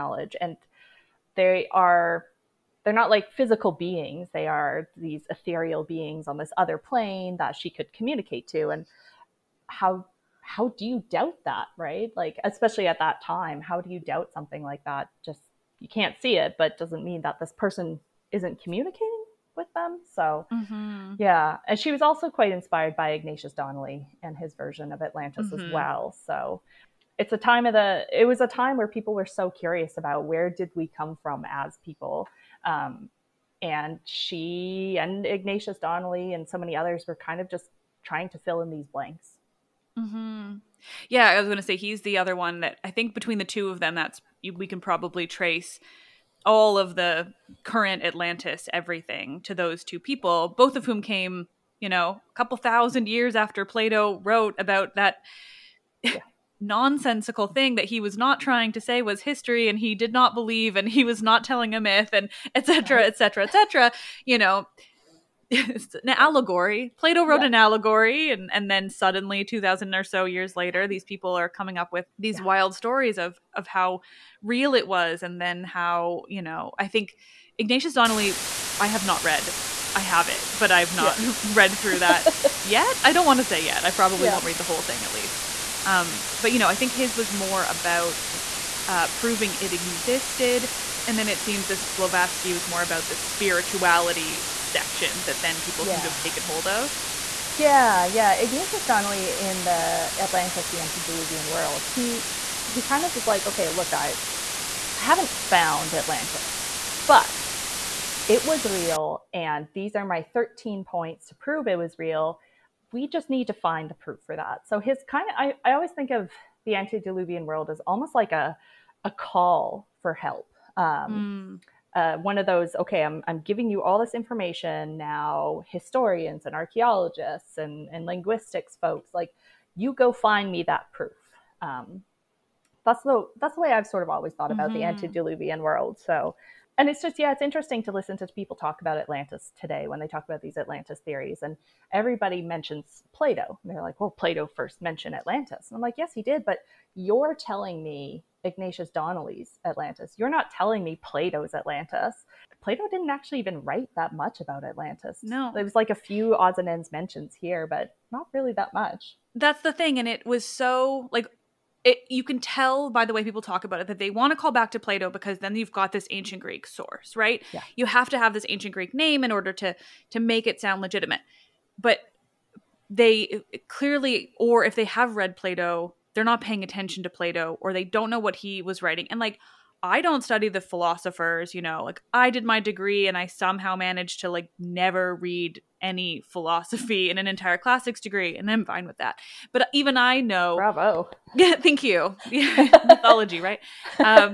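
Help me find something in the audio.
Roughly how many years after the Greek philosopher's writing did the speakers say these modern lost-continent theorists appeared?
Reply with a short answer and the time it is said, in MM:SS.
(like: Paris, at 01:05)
2000, at 01:09.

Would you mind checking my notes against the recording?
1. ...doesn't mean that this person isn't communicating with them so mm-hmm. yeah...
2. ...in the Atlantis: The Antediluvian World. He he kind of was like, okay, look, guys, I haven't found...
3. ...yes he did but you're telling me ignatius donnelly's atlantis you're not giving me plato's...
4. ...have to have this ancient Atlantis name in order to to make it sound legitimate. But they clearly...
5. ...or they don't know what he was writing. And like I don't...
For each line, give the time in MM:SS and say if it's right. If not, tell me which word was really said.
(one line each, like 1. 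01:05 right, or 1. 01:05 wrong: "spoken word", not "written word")
1. 00:16 right
2. 01:39 right
3. 02:25 wrong: "telling", not "giving"
4. 02:47 wrong: "Greek", not "Atlantis"
5. 02:57 right.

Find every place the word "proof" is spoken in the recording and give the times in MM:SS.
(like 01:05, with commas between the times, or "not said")
01:53, 02:10.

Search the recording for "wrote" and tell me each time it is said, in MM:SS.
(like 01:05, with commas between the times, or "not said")
00:54, 01:07.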